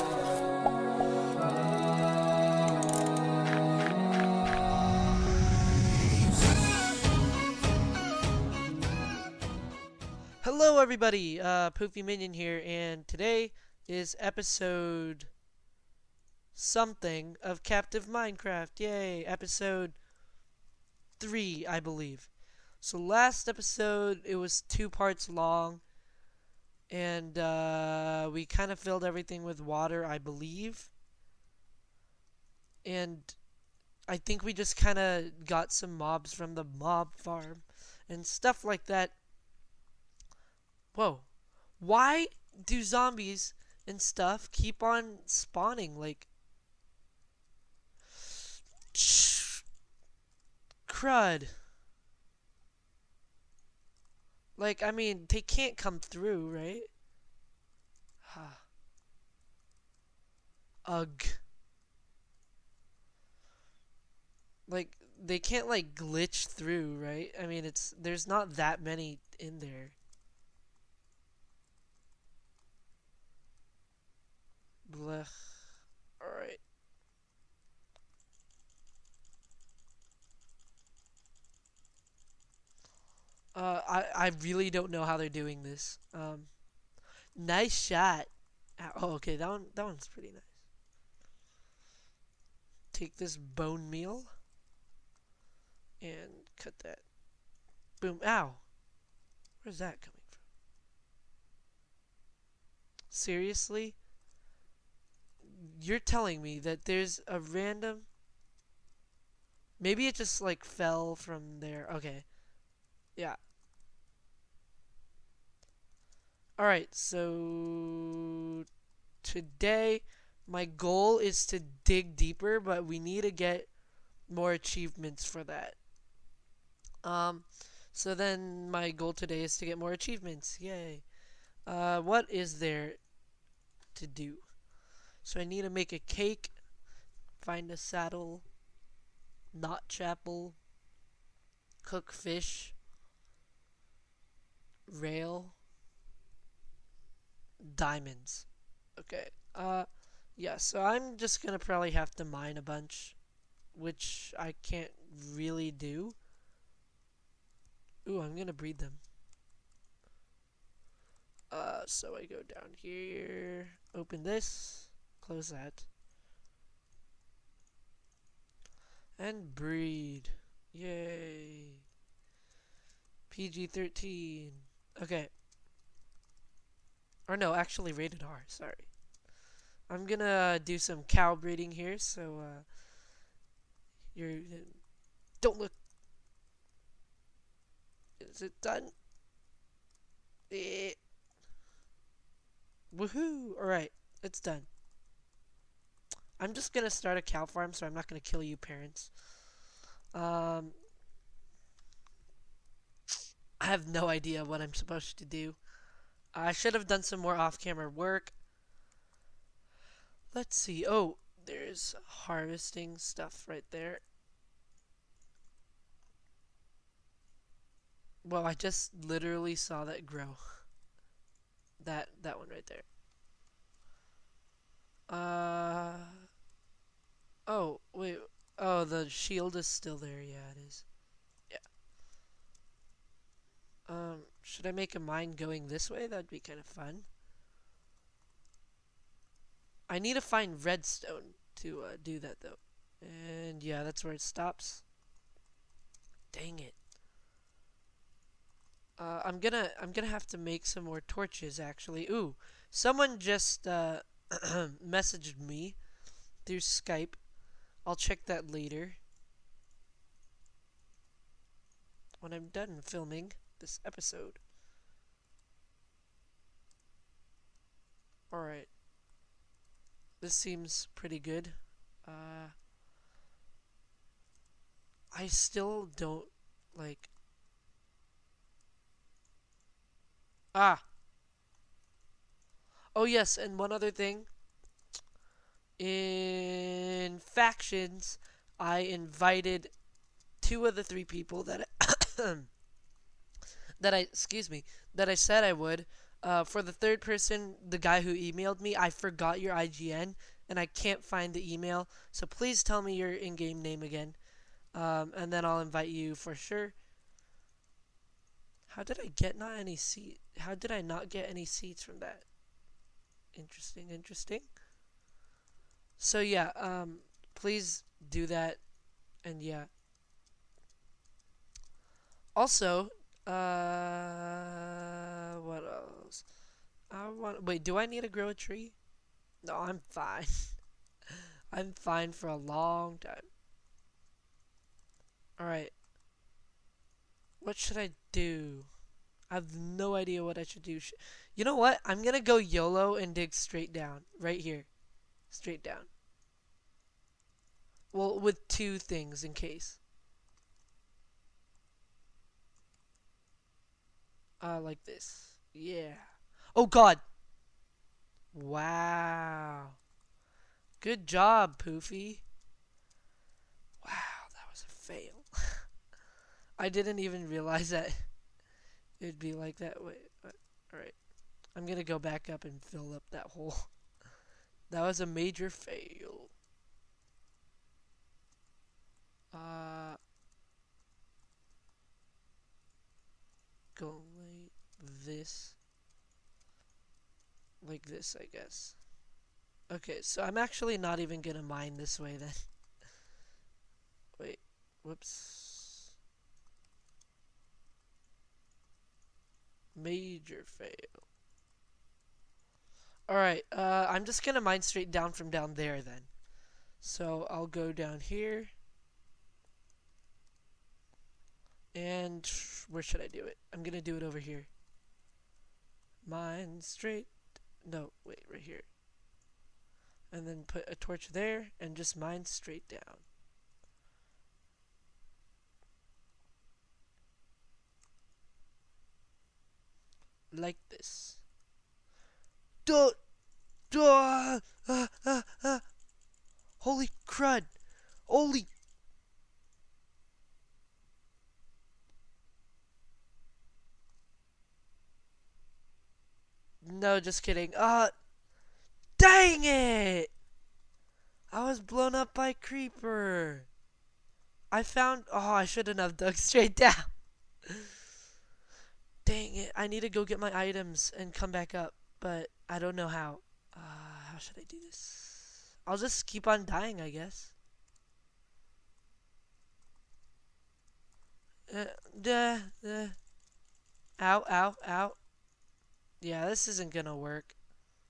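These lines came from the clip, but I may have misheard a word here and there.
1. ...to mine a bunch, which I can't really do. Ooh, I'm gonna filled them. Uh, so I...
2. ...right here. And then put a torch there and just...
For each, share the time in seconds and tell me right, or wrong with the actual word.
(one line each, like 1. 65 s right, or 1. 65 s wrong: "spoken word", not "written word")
1. 152 s wrong: "breed", not "filled"
2. 418 s right.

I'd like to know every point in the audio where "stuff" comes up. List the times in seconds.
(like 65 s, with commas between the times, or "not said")
38 s, 44 s, 212 s.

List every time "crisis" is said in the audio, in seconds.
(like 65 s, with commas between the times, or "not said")
not said.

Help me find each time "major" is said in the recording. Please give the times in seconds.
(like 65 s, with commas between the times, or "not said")
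375 s, 399 s.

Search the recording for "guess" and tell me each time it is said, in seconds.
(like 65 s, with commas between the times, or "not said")
388 s, 466 s.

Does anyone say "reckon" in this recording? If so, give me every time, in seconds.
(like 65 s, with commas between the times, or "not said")
not said.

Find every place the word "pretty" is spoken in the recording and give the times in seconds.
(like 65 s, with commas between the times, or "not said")
90 s, 270 s.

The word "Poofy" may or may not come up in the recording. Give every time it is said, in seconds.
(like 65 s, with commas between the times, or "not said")
11 s, 361 s.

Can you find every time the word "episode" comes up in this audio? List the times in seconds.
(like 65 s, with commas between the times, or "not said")
14 s, 19 s, 23 s, 263 s.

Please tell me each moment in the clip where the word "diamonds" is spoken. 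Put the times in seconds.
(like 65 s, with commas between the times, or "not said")
147 s.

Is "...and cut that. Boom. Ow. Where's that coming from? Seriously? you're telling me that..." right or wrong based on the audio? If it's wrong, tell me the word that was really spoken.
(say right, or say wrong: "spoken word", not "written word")
right.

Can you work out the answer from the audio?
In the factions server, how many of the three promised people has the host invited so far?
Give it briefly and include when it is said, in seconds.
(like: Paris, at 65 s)
2, at 290 s.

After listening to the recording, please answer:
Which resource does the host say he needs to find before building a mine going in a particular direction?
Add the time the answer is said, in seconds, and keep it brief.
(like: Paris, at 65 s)
redstone, at 240 s.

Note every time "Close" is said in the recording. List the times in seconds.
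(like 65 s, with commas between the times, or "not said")
165 s.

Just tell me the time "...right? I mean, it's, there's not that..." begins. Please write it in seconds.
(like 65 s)
66 s.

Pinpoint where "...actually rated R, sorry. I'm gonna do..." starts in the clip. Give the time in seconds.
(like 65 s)
177 s.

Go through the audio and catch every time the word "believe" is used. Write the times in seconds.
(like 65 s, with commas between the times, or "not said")
21 s, 30 s.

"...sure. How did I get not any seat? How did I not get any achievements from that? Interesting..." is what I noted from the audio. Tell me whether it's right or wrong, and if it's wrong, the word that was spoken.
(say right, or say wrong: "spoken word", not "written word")
wrong: "seats", not "achievements".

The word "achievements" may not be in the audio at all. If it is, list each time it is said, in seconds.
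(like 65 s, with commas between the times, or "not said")
124 s, 129 s.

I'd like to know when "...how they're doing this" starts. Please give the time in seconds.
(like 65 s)
85 s.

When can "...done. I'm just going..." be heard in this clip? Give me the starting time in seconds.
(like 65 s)
194 s.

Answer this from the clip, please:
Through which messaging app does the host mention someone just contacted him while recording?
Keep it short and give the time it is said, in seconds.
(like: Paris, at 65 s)
Skype, at 256 s.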